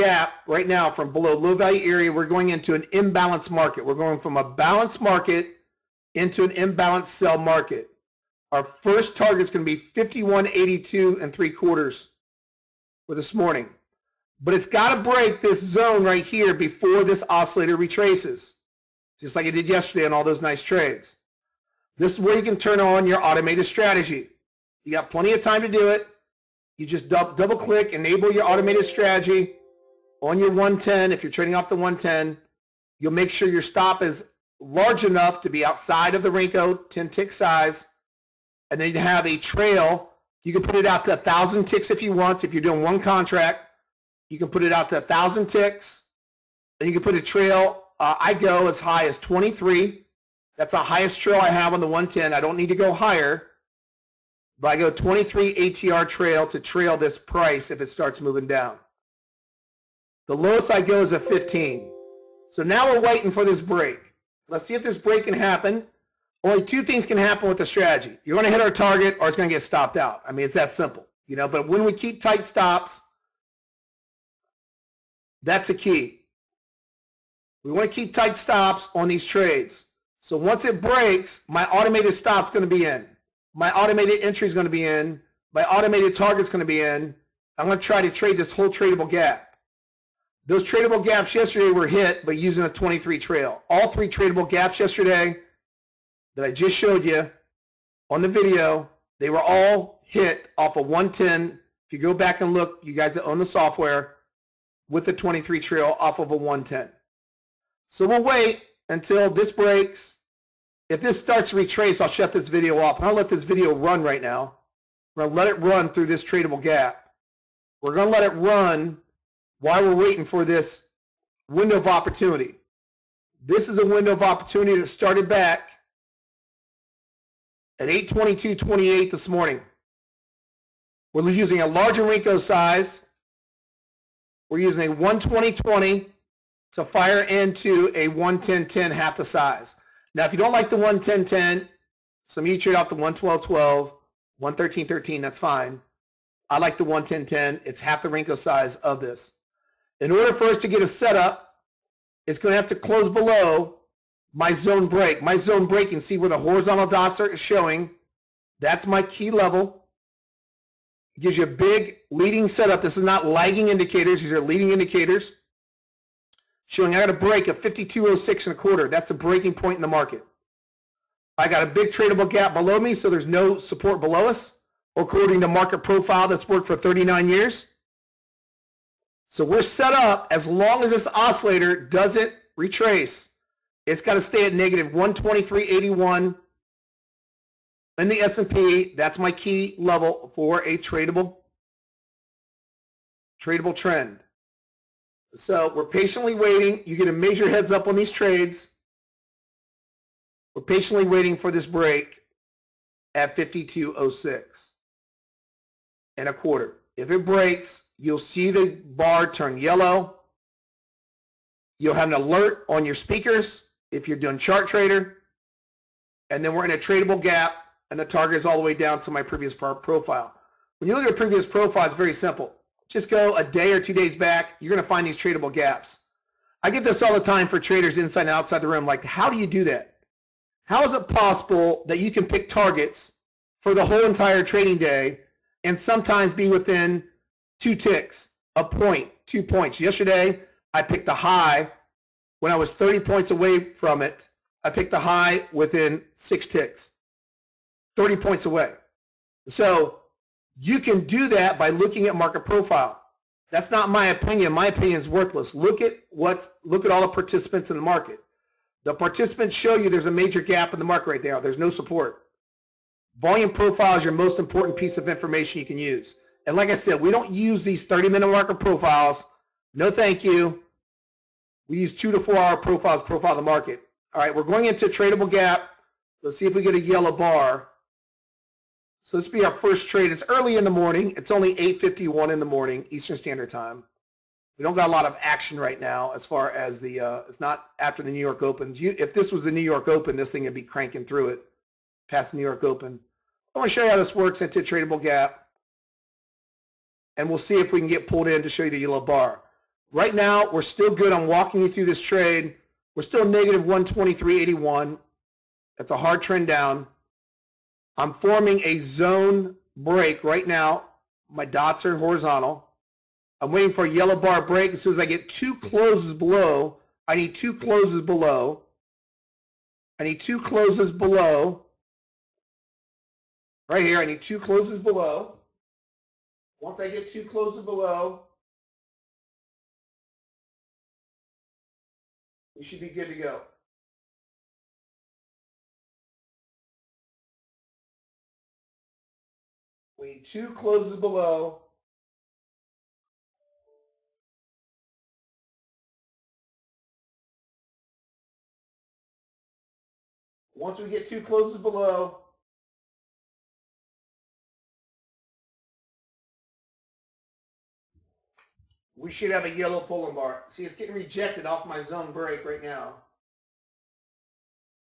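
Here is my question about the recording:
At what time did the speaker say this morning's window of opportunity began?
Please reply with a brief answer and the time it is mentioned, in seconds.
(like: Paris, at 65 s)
8:22, at 127 s.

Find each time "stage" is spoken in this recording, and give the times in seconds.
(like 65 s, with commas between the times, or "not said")
not said.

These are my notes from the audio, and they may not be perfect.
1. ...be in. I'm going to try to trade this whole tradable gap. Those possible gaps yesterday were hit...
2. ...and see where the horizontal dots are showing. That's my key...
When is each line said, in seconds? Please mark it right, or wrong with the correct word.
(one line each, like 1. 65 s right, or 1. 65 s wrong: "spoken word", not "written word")
1. 86 s wrong: "tradable", not "possible"
2. 155 s right.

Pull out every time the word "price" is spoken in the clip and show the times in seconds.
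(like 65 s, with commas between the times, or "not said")
57 s.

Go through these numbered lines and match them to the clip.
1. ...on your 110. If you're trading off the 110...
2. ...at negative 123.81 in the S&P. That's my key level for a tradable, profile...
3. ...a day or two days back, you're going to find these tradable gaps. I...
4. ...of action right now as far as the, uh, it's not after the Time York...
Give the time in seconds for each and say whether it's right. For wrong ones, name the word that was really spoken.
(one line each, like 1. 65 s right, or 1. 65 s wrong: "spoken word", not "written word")
1. 30 s right
2. 184 s wrong: "tradable", not "profile"
3. 223 s right
4. 285 s wrong: "New", not "Time".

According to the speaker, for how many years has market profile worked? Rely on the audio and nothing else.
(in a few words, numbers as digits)
39 years.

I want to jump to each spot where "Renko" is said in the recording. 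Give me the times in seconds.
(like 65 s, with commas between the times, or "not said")
36 s, 132 s, 148 s.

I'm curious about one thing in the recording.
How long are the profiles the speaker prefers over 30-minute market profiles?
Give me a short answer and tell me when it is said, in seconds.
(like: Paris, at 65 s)
2 to 4 hours, at 271 s.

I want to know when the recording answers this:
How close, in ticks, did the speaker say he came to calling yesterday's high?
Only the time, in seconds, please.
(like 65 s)
245 s.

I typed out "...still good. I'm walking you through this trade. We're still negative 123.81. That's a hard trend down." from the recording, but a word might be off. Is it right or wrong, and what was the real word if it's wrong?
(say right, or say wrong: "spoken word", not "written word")
right.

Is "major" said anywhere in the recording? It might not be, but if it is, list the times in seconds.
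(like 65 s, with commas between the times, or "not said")
197 s, 260 s.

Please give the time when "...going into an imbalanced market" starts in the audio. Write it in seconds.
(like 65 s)
2 s.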